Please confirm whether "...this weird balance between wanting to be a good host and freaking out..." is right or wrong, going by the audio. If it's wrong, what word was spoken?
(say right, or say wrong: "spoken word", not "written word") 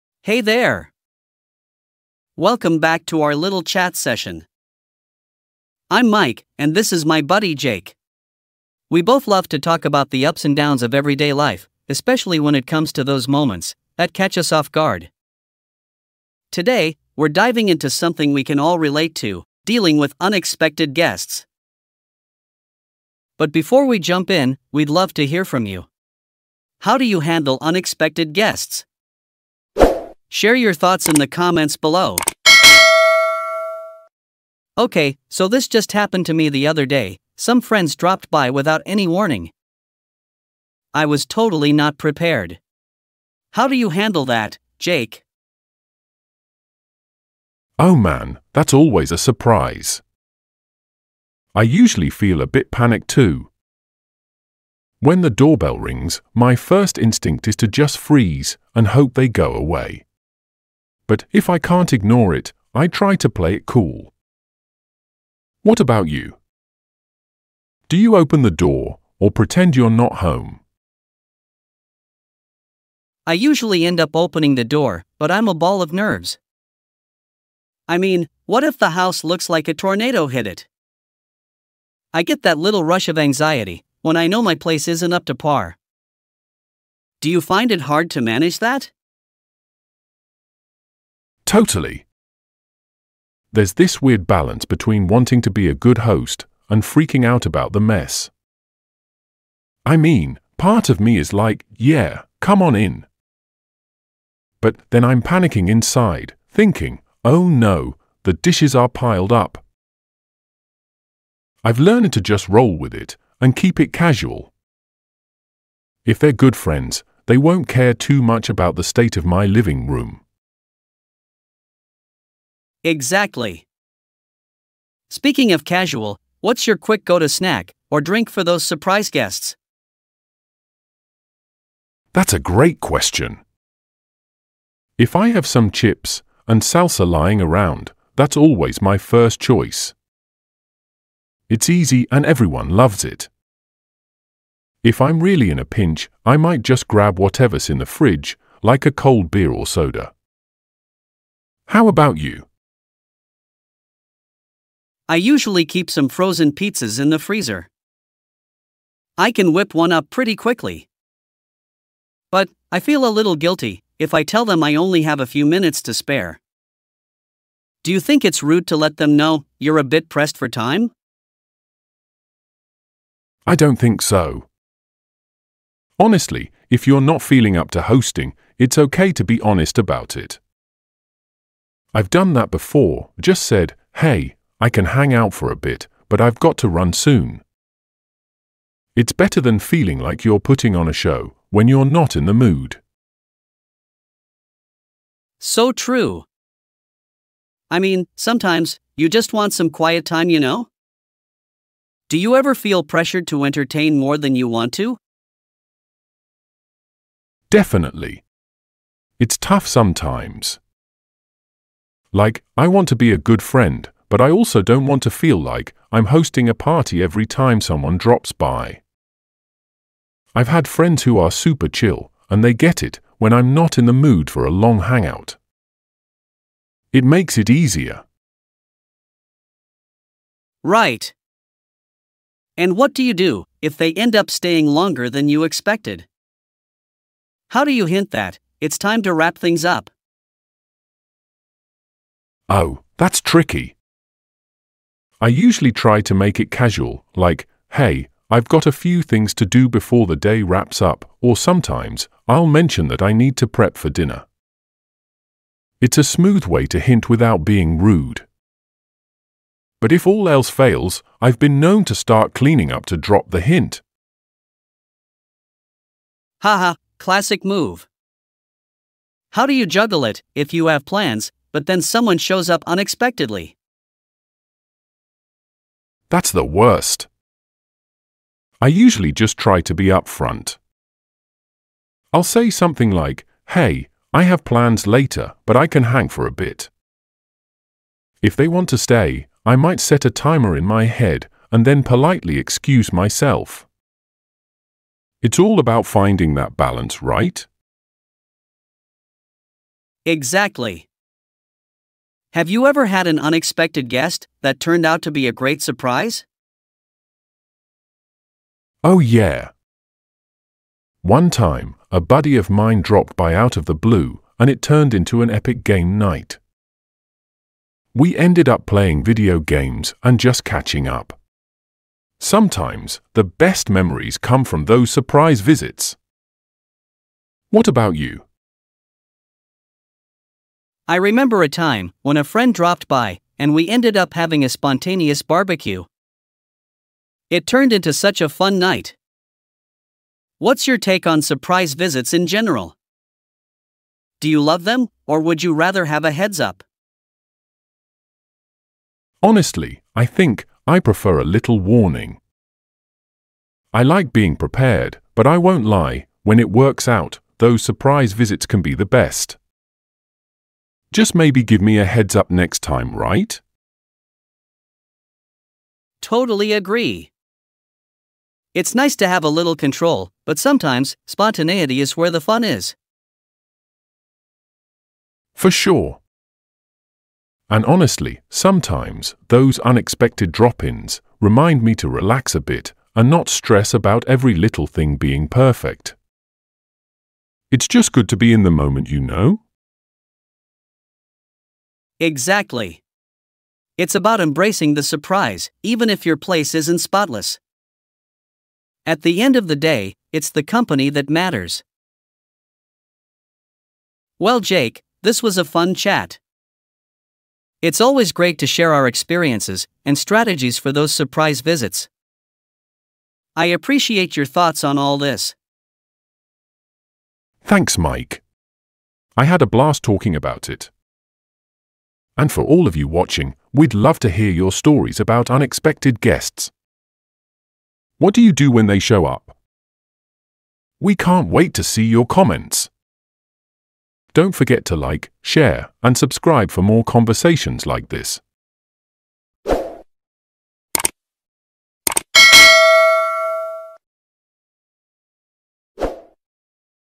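right.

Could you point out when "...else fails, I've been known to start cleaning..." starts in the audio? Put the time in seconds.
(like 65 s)
260 s.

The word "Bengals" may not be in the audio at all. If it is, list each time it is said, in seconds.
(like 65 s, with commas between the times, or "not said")
not said.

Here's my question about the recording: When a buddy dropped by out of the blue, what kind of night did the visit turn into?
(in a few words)
game night.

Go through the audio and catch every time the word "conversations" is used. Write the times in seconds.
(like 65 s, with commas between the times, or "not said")
436 s.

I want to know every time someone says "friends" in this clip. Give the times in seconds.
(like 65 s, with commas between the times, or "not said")
37 s, 116 s, 213 s, 220 s, 332 s.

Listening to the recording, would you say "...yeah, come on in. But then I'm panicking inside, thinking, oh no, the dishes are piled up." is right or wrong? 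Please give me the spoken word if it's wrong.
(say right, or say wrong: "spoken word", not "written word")
right.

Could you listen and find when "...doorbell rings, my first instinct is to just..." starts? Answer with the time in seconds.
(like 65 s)
55 s.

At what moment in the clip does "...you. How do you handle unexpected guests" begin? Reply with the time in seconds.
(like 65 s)
25 s.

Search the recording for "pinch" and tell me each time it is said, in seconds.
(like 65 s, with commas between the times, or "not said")
145 s.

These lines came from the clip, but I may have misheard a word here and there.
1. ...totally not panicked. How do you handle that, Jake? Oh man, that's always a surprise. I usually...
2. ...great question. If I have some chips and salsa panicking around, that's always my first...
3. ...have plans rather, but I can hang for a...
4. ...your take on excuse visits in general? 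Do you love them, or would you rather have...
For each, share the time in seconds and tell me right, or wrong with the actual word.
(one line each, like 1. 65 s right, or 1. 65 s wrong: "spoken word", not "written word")
1. 41 s wrong: "prepared", not "panicked"
2. 132 s wrong: "lying", not "panicking"
3. 284 s wrong: "later", not "rather"
4. 340 s wrong: "surprise", not "excuse".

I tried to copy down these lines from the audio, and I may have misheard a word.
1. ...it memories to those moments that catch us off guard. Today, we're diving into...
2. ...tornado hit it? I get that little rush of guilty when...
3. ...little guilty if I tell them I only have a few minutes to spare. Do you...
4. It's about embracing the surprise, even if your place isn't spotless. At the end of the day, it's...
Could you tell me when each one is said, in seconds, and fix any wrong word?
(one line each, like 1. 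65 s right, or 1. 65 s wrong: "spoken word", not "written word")
1. 12 s wrong: "comes", not "memories"
2. 79 s wrong: "anxiety", not "guilty"
3. 163 s right
4. 393 s right.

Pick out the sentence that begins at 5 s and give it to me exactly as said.
I'm Mike, and this is my buddy Jake.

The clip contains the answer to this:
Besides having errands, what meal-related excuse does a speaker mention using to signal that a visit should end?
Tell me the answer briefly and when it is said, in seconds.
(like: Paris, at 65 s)
prep for dinner, at 253 s.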